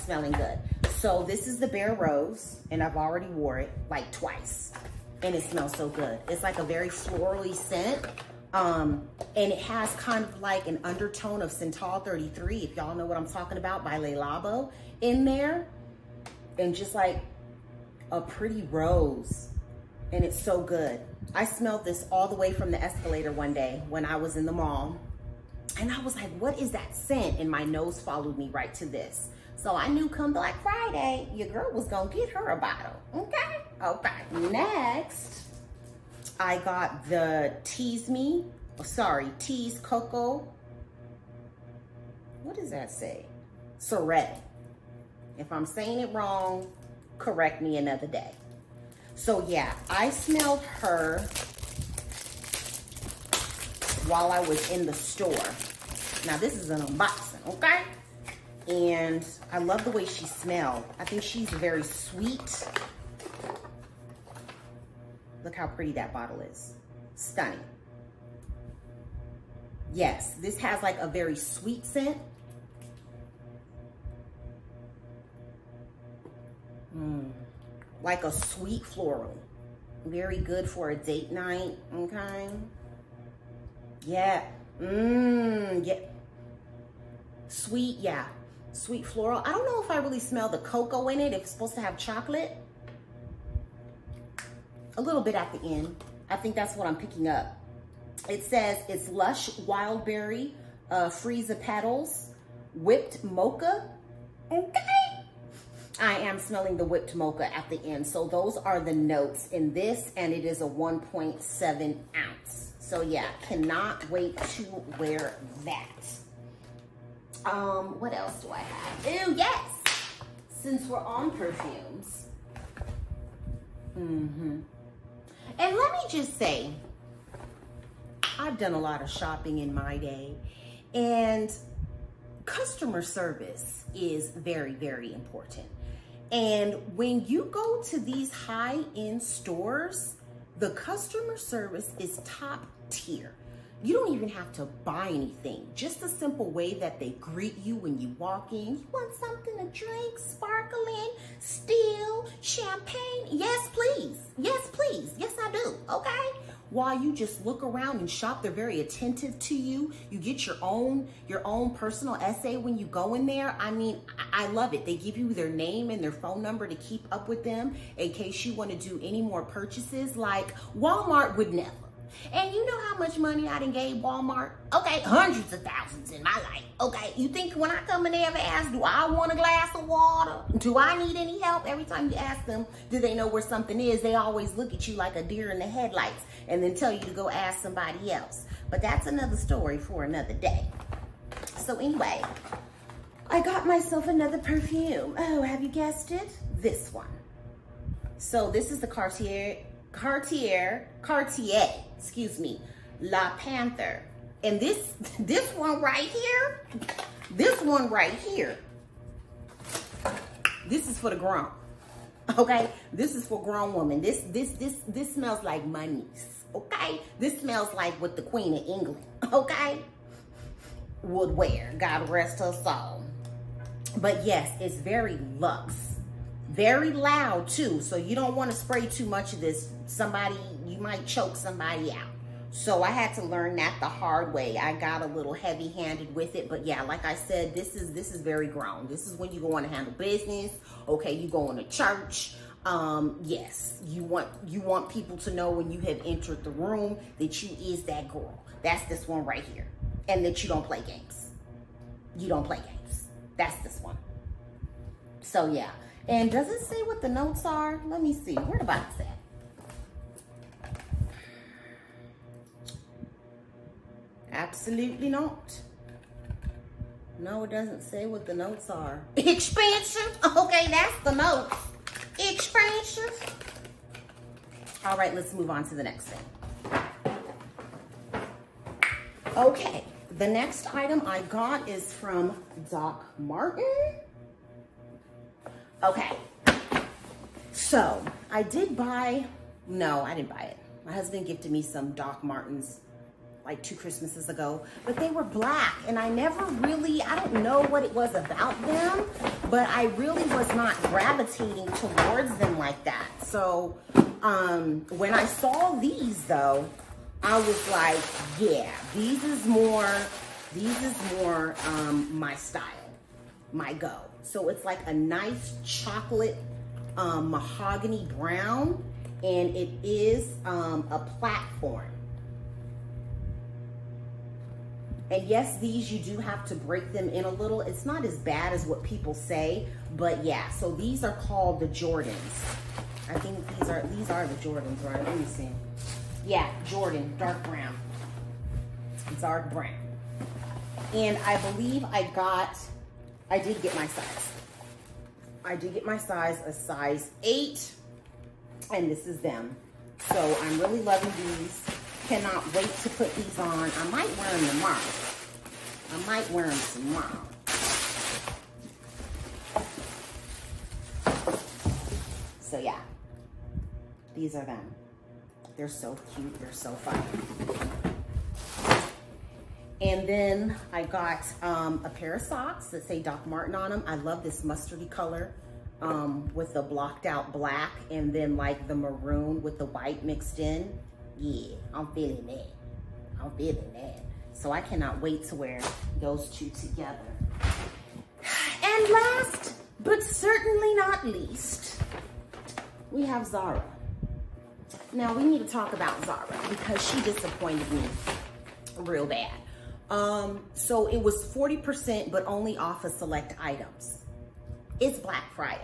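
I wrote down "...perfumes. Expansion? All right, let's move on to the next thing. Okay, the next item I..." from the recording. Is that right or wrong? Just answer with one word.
wrong.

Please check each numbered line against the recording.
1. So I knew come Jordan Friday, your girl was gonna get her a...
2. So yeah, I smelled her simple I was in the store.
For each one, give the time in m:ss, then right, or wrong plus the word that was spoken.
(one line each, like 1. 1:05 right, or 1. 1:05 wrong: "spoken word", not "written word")
1. 0:29 wrong: "Black", not "Jordan"
2. 0:49 wrong: "while", not "simple".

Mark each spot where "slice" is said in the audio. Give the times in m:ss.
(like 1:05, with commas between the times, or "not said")
not said.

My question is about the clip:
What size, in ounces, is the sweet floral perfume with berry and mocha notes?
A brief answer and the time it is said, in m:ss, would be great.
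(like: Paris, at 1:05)
1.7 ounces, at 1:50.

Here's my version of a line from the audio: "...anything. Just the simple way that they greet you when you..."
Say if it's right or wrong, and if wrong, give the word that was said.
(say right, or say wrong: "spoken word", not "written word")
right.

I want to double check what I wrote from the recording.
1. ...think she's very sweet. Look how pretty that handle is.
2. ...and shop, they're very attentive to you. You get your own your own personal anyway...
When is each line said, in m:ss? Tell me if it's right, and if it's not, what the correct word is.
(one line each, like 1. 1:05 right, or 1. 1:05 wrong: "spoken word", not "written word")
1. 1:01 wrong: "bottle", not "handle"
2. 2:37 wrong: "essay", not "anyway".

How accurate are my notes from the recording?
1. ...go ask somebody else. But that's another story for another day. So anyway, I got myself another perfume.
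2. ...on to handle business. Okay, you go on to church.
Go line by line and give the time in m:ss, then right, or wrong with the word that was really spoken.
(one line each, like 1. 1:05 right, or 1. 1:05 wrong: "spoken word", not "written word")
1. 3:07 right
2. 3:59 right.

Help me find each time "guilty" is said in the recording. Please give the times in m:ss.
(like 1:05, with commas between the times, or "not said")
not said.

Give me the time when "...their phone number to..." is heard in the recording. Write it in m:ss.
2:46.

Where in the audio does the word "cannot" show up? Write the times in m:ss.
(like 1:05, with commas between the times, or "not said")
1:53, 5:52, 6:24.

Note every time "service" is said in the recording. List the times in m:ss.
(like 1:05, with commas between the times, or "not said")
2:13, 2:21.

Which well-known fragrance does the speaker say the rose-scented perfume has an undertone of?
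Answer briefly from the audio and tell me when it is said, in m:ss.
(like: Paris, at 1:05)
Santal 33, at 0:11.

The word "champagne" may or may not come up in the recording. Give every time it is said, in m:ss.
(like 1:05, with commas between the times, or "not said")
2:32.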